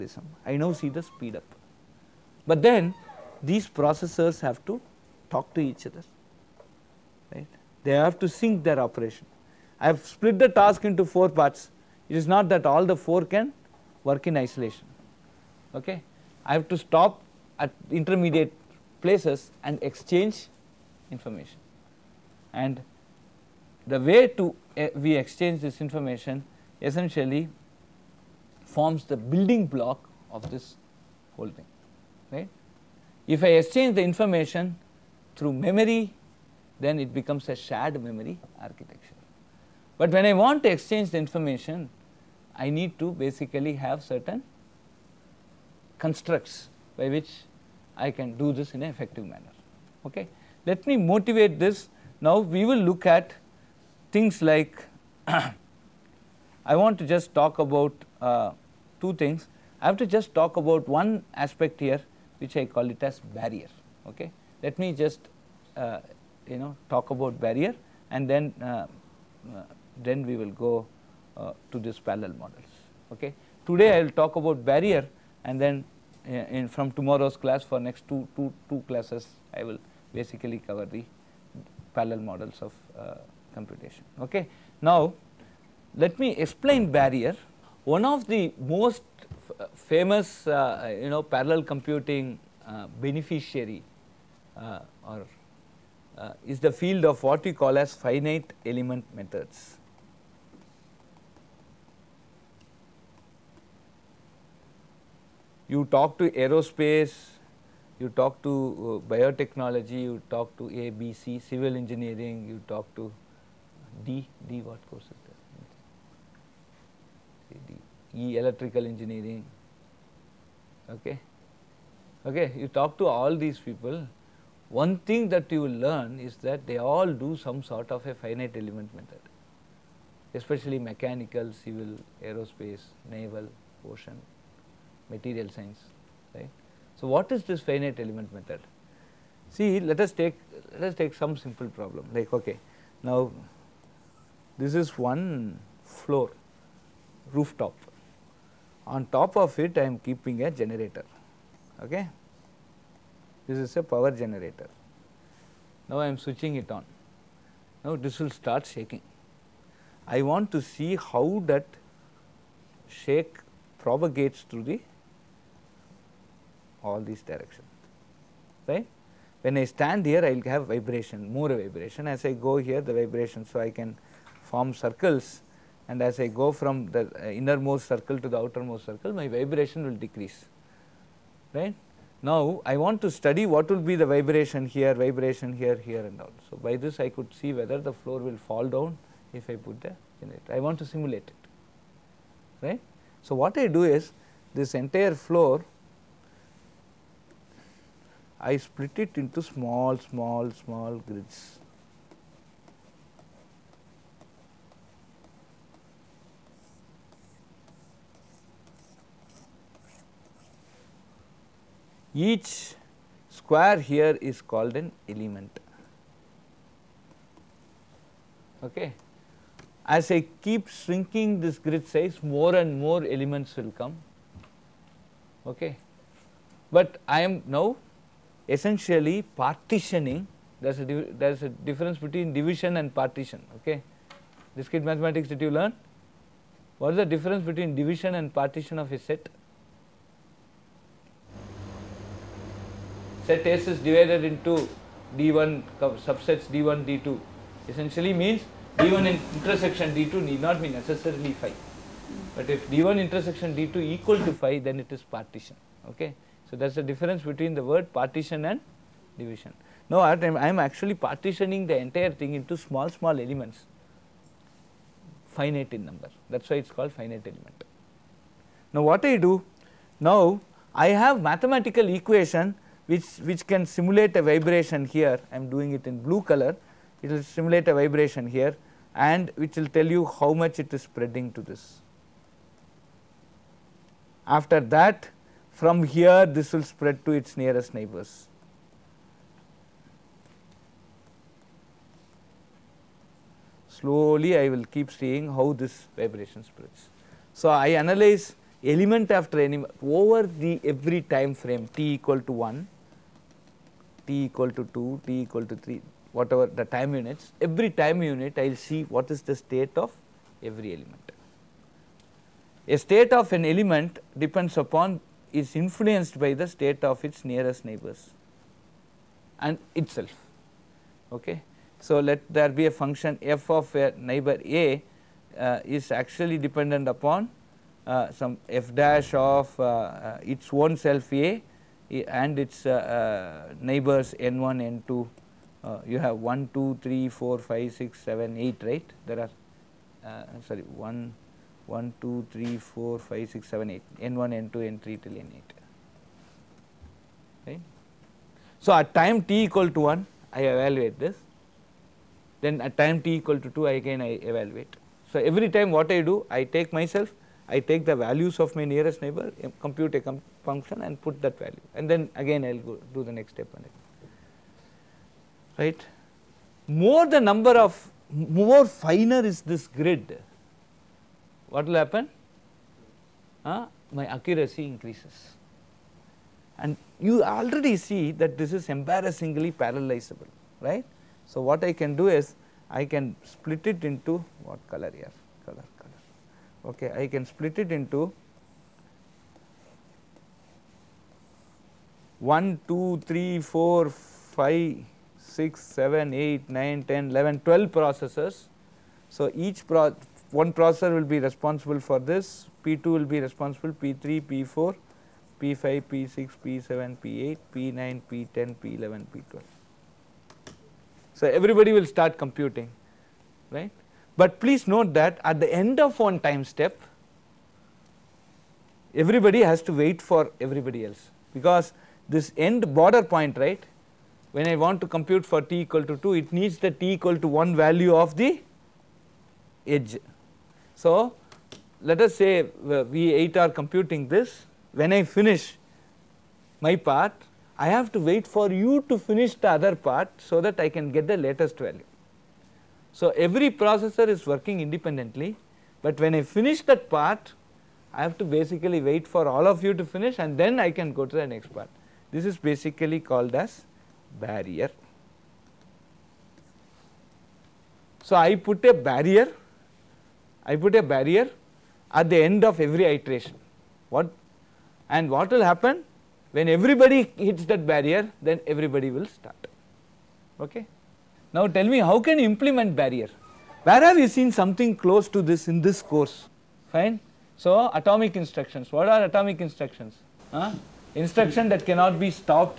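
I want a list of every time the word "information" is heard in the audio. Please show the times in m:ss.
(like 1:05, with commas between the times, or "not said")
0:21, 0:25, 0:34, 0:41.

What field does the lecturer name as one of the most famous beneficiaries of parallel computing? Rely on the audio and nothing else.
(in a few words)
finite element methods.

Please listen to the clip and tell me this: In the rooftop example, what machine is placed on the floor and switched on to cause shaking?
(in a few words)
power generator.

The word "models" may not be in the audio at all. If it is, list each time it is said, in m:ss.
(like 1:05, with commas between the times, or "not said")
1:12, 1:22.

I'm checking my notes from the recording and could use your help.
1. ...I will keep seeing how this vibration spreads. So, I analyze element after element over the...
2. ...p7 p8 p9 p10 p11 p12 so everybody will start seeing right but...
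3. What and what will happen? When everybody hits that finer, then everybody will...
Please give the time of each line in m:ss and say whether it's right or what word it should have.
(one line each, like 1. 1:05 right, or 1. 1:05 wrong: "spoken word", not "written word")
1. 4:54 right
2. 6:46 wrong: "computing", not "seeing"
3. 7:43 wrong: "barrier", not "finer".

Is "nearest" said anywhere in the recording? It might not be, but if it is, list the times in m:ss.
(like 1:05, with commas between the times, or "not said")
4:47, 5:17, 5:58.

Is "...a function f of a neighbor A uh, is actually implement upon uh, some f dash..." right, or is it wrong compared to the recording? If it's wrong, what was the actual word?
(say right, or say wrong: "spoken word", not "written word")
wrong: "dependent", not "implement".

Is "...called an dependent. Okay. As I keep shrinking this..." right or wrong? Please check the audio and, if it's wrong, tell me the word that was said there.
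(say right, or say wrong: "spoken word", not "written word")
wrong: "element", not "dependent".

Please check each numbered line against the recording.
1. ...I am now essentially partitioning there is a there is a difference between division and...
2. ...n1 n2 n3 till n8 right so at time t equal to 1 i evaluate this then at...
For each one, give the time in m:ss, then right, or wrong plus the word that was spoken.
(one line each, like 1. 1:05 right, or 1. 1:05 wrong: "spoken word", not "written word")
1. 3:47 right
2. 5:43 right.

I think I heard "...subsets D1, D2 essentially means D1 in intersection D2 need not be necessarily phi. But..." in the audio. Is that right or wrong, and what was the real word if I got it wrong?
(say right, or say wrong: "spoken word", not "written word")
right.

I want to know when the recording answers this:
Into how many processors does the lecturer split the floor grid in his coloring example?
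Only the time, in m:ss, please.
6:37.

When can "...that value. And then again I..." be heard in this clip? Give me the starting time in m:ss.
6:01.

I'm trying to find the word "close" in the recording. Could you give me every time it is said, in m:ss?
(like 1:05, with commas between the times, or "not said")
7:54.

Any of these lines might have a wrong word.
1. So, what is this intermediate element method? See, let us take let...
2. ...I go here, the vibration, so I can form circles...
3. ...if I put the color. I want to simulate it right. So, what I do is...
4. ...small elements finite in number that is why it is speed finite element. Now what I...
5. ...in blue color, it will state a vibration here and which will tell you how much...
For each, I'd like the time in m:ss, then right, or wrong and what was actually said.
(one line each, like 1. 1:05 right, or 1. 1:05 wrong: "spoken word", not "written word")
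1. 2:16 wrong: "finite", not "intermediate"
2. 2:52 right
3. 3:09 wrong: "generator", not "color"
4. 4:22 wrong: "called", not "speed"
5. 4:35 wrong: "simulate", not "state".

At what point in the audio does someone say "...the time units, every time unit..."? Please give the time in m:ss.
5:06.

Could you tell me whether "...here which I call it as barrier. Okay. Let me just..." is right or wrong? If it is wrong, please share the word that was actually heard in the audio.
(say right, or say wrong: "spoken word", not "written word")
right.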